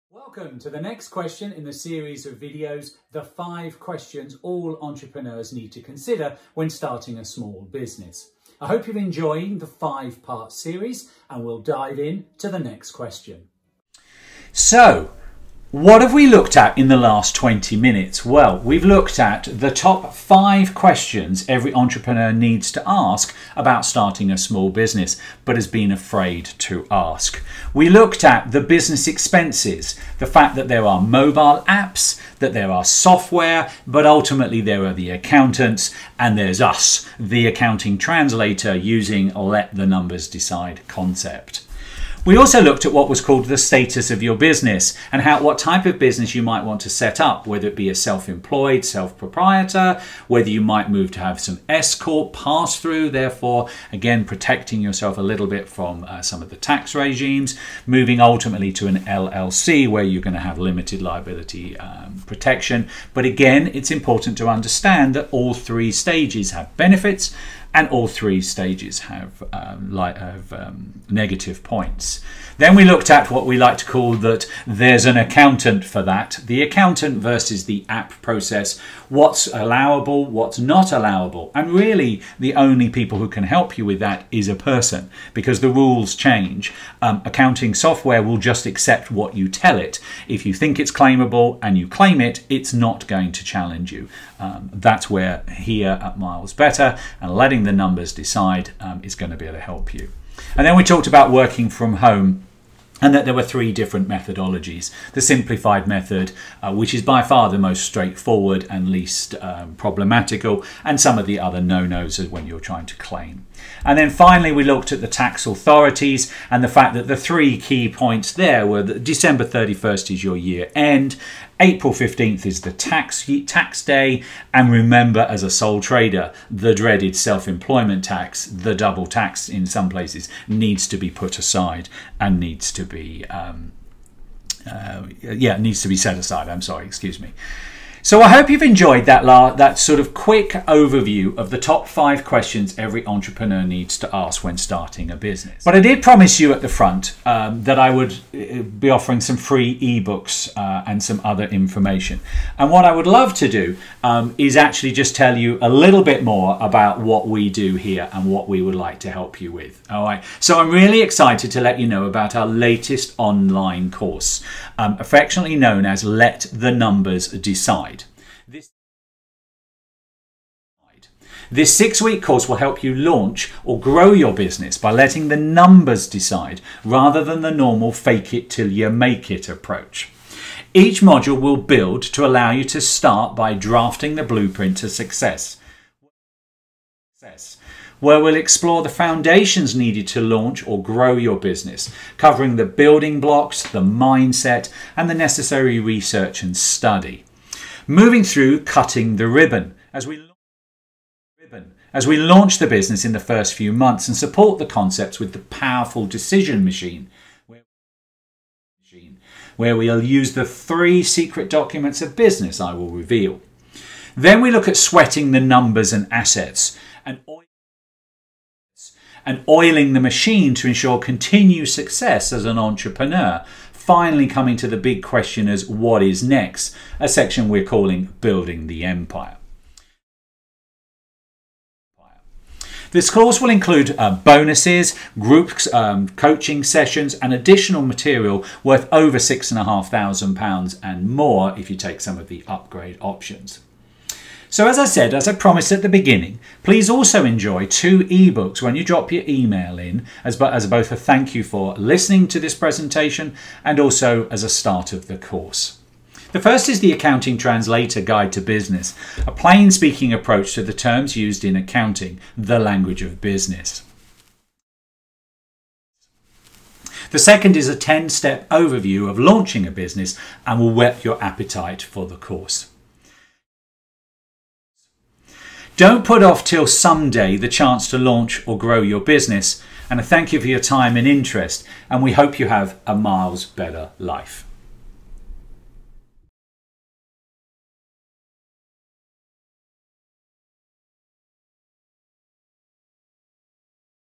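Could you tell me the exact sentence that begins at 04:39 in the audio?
And I thank you for your time and interest, and we hope you have a miles better life.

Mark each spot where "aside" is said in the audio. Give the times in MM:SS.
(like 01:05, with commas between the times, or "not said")
02:11, 02:16.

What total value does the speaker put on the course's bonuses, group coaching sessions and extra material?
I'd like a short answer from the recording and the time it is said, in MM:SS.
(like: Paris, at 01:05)
£6,500, at 03:59.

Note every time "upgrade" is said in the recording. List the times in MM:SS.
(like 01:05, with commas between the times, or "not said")
04:02.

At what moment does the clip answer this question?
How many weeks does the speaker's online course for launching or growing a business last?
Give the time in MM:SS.
02:51.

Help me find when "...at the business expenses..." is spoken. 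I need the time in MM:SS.
00:28.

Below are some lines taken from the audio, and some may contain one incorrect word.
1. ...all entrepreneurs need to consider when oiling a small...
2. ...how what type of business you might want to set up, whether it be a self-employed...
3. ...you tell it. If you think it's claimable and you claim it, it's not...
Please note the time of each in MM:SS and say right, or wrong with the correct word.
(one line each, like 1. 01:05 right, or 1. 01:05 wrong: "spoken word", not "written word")
1. 00:04 wrong: "starting", not "oiling"
2. 00:45 right
3. 01:29 right.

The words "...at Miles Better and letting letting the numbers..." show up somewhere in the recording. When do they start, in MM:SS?
01:36.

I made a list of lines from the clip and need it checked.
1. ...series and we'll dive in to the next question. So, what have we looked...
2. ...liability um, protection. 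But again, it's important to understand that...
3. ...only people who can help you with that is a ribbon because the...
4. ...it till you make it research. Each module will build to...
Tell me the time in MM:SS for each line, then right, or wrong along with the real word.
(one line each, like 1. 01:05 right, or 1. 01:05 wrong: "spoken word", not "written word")
1. 00:10 right
2. 01:01 right
3. 01:22 wrong: "person", not "ribbon"
4. 02:58 wrong: "approach", not "research".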